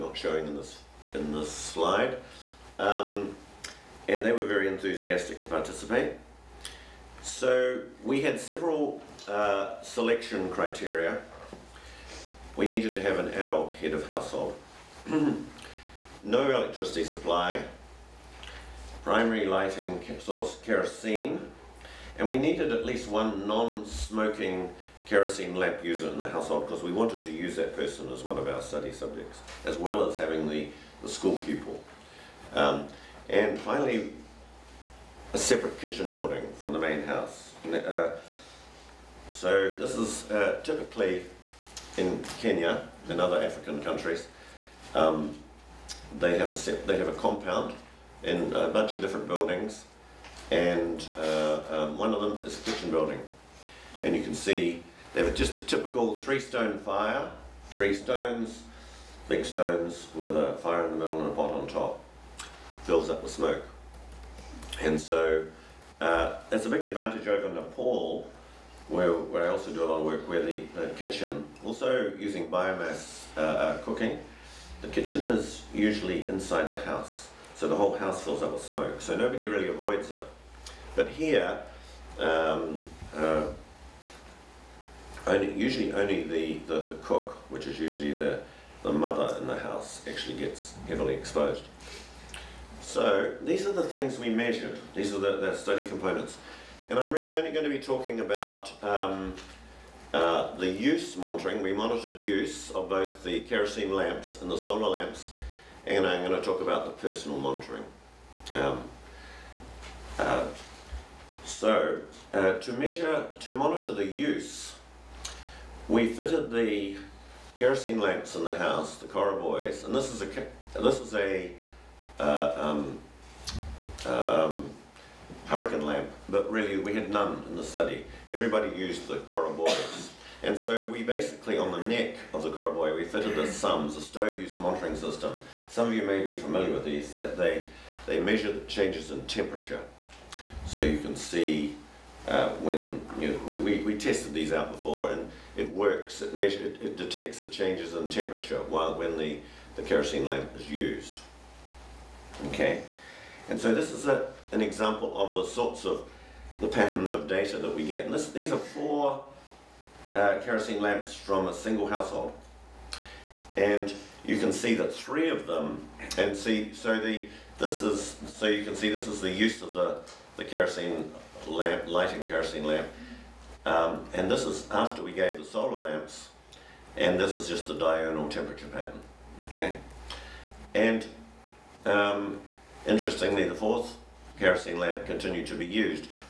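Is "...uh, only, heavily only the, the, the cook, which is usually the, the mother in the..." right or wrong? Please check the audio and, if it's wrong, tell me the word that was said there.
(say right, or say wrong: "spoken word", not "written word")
wrong: "usually", not "heavily".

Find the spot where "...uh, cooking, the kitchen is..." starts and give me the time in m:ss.
1:13.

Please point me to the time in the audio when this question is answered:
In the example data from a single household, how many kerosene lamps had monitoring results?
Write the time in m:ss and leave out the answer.
2:38.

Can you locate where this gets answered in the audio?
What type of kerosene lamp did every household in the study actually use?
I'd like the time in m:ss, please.
2:09.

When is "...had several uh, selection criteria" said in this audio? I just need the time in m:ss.
0:08.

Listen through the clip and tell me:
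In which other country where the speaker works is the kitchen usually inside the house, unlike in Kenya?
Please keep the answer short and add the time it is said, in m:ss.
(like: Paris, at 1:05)
Nepal, at 1:07.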